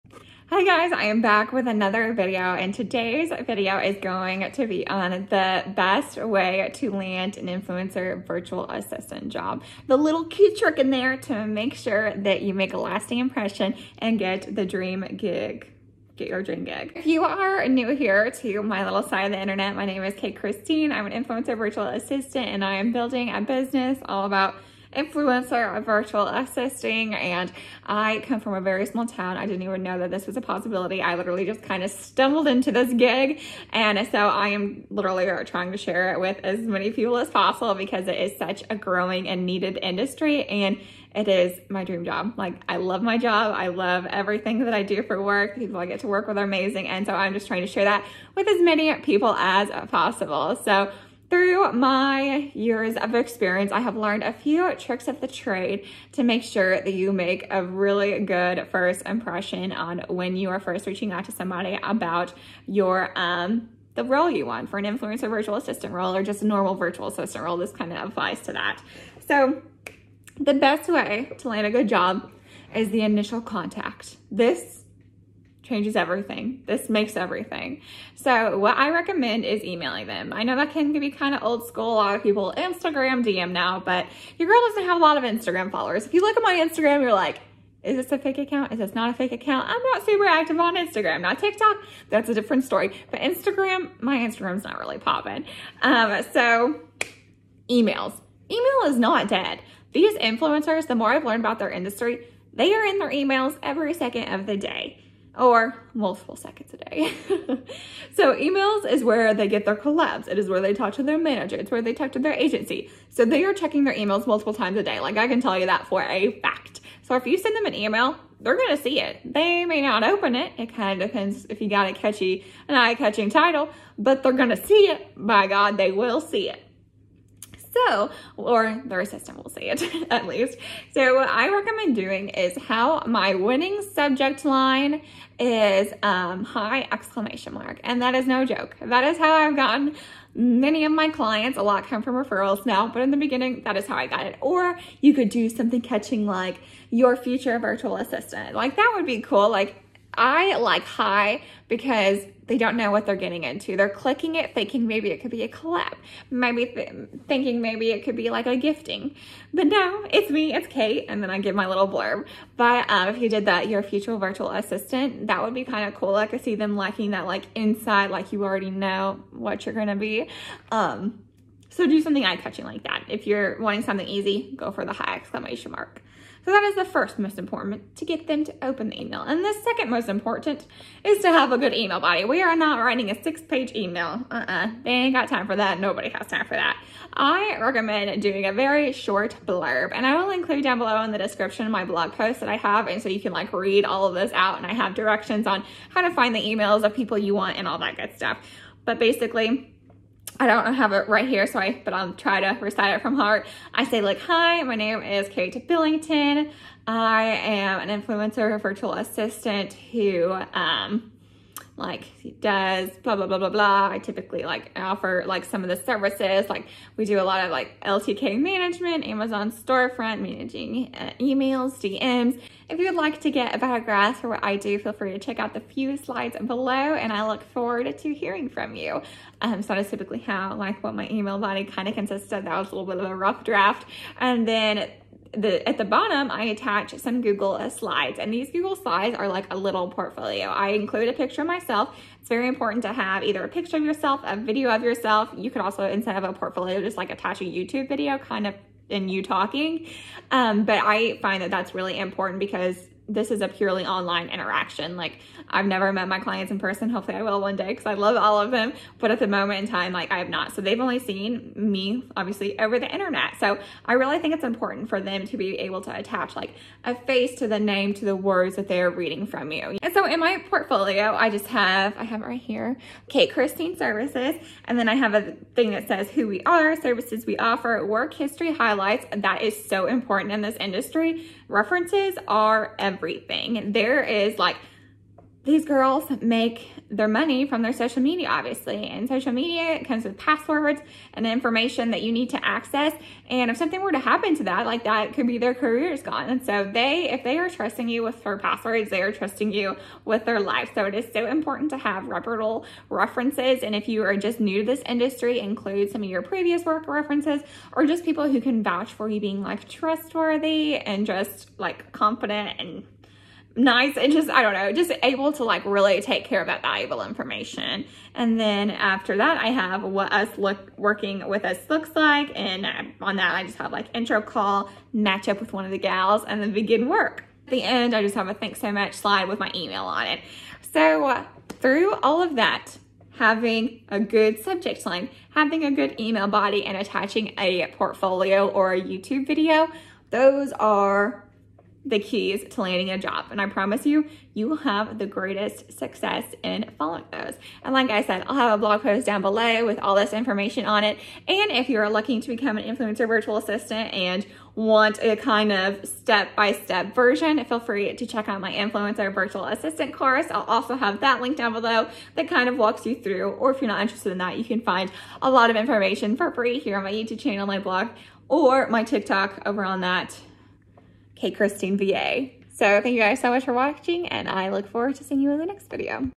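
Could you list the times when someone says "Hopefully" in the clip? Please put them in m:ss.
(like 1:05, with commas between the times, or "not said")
4:16.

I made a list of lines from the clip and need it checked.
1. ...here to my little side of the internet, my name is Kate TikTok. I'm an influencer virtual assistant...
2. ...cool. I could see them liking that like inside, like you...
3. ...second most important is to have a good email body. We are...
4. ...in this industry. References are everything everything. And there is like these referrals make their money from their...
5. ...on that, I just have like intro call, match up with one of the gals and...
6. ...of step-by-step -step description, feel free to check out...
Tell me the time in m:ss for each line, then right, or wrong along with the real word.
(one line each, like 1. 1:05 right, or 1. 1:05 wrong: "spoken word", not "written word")
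1. 0:17 wrong: "Christine", not "TikTok"
2. 2:45 right
3. 2:59 right
4. 4:40 wrong: "girls", not "referrals"
5. 5:23 right
6. 5:55 wrong: "version", not "description".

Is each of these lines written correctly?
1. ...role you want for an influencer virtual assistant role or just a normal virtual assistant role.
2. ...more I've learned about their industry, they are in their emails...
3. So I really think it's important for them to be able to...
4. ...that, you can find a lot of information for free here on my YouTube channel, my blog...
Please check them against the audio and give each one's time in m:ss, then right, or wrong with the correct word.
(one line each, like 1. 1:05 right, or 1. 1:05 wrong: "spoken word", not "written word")
1. 1:04 right
2. 1:40 right
3. 4:23 right
4. 6:04 right.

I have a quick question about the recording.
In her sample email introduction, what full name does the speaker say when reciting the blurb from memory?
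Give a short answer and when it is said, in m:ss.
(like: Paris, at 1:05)
Carrie Billington, at 3:25.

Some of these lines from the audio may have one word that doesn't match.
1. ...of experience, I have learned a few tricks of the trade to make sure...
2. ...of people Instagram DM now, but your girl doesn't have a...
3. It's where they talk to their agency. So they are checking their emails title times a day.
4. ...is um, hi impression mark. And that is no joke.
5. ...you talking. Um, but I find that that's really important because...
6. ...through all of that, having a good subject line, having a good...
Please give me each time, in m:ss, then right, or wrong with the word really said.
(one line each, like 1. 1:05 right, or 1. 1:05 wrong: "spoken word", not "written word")
1. 0:52 right
2. 1:22 right
3. 1:51 wrong: "multiple", not "title"
4. 2:15 wrong: "exclamation", not "impression"
5. 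4:09 right
6. 5:31 right.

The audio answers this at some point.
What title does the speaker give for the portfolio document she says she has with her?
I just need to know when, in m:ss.
4:33.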